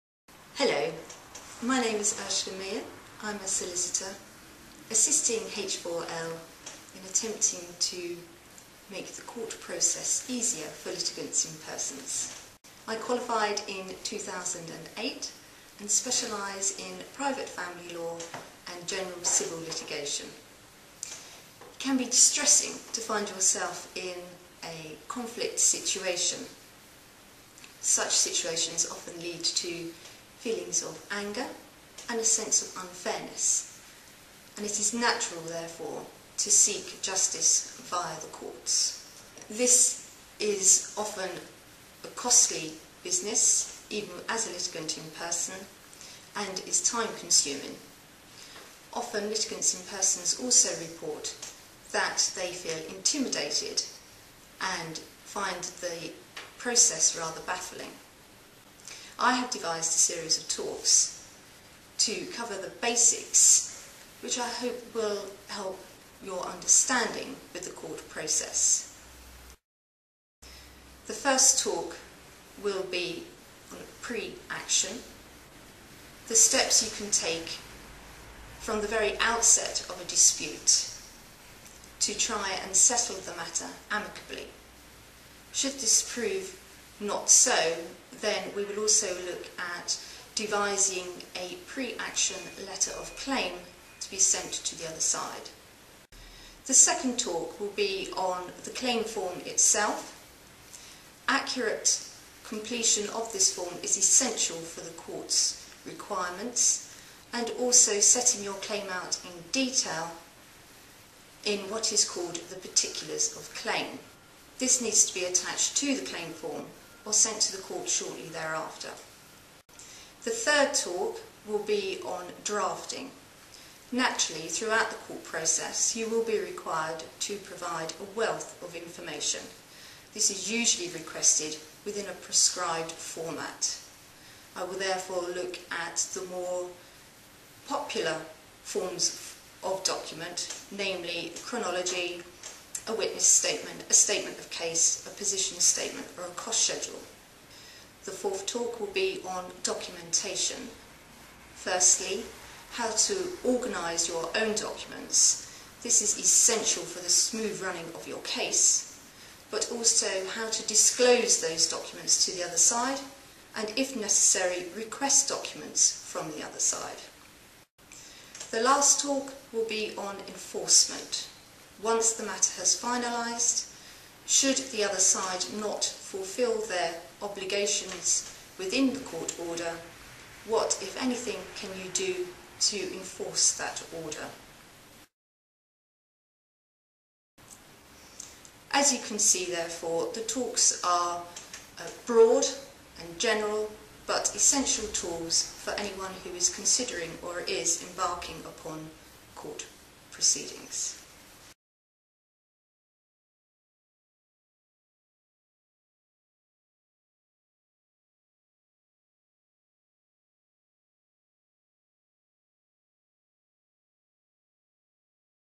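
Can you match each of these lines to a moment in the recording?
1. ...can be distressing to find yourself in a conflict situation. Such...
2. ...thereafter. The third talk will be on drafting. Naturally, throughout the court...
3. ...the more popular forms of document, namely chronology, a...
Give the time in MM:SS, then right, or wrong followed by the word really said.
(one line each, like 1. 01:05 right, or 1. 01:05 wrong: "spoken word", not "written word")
1. 00:21 right
2. 01:58 right
3. 02:16 right.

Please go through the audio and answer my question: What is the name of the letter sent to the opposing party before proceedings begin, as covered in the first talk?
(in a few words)
letter of claim.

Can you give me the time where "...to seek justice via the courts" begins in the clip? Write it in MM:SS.
00:36.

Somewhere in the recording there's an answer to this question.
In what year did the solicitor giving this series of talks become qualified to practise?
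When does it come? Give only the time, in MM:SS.
00:14.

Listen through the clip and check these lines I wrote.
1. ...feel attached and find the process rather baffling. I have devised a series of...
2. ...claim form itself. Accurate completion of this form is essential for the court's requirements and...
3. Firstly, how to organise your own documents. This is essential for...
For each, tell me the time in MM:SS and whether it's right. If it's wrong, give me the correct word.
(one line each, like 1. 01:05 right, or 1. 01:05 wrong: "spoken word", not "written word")
1. 00:52 wrong: "intimidated", not "attached"
2. 01:38 right
3. 02:31 right.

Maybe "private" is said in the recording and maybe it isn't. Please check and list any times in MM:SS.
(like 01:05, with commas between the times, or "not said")
00:17.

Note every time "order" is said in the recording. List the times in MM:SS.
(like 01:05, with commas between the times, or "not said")
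02:59, 03:04.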